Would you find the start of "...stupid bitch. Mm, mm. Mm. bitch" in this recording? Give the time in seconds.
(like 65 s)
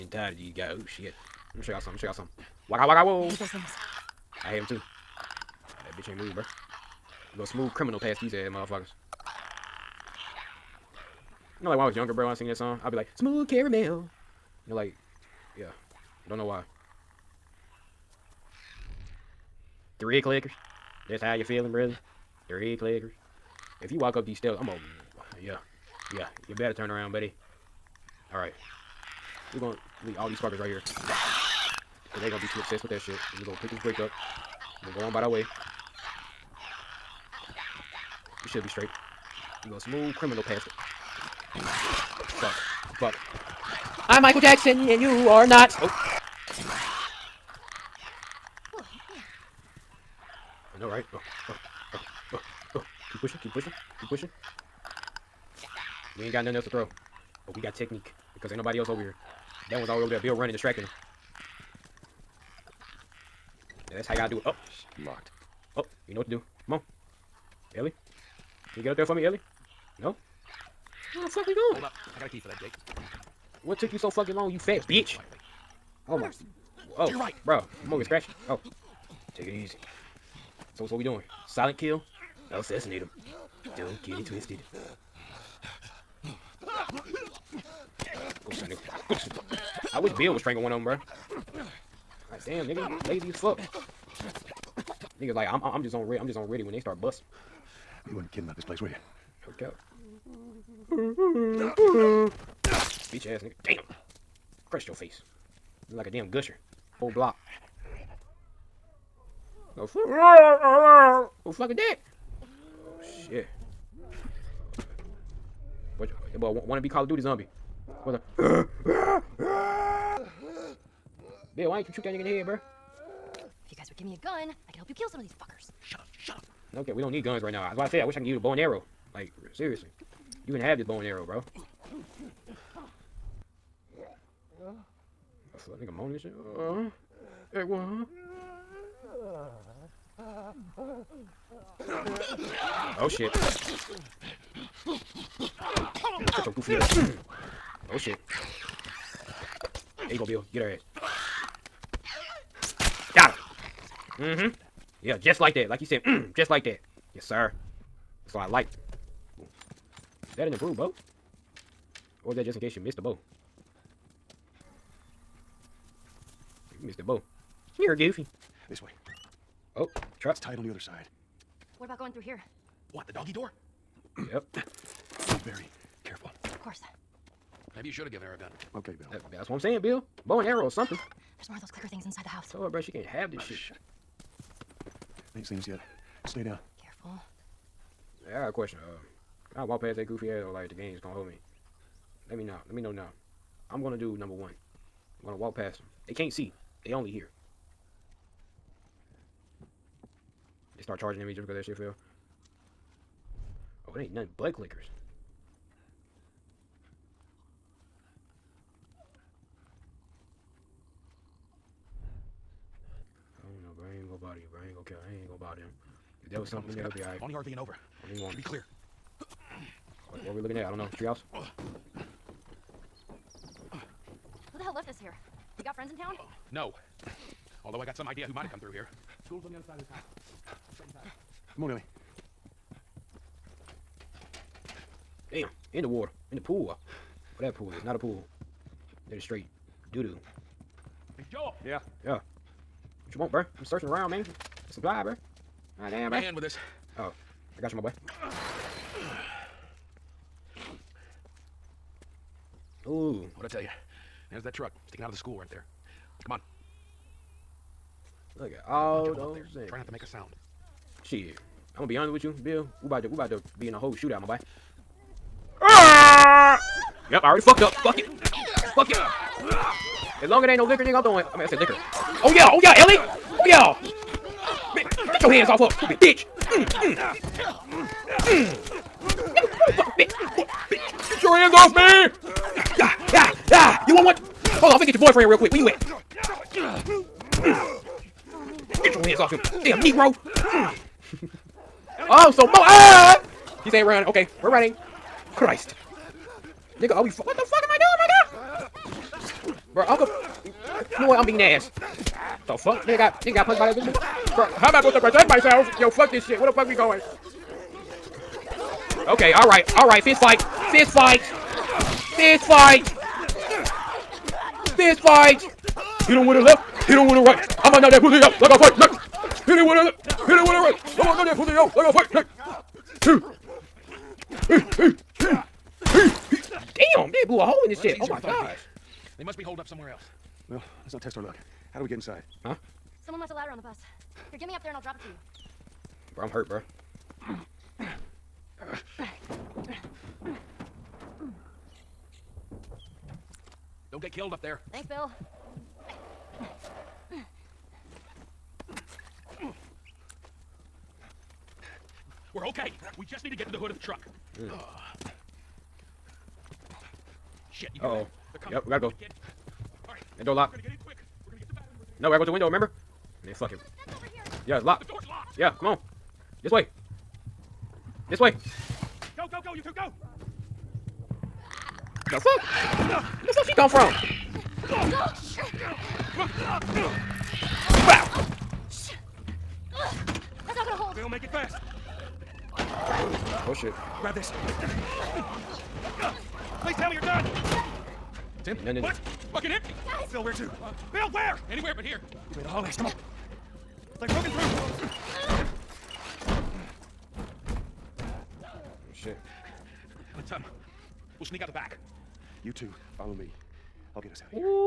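275 s.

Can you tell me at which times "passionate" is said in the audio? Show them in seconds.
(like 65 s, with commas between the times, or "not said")
not said.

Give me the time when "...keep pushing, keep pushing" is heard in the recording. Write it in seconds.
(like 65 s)
53 s.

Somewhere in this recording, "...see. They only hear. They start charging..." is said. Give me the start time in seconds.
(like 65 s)
196 s.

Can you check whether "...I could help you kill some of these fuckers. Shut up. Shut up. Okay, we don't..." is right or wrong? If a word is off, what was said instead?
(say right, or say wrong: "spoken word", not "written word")
right.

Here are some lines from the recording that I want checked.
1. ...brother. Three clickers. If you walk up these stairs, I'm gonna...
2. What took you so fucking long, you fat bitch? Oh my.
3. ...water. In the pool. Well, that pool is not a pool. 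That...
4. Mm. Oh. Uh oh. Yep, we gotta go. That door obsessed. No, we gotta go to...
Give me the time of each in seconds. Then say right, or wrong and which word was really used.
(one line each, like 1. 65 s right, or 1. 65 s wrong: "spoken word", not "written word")
1. 21 s right
2. 73 s right
3. 235 s right
4. 354 s wrong: "locked", not "obsessed".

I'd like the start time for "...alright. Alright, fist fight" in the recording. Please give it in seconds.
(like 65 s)
309 s.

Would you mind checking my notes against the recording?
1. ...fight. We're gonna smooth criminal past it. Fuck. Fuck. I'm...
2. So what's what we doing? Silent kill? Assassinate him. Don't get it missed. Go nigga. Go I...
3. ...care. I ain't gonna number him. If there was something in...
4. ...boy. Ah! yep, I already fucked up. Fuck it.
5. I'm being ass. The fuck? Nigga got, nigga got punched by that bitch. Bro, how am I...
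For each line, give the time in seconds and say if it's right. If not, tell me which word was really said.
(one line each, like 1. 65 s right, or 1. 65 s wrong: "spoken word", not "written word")
1. 38 s wrong: "straight", not "fight"
2. 80 s wrong: "twisted", not "missed"
3. 214 s wrong: "bother", not "number"
4. 264 s right
5. 301 s right.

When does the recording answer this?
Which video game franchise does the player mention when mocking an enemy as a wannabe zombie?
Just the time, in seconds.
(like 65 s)
116 s.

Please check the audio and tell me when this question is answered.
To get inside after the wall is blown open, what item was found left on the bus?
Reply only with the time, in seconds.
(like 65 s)
333 s.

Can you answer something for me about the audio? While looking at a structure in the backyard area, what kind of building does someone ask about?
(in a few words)
Treehouse.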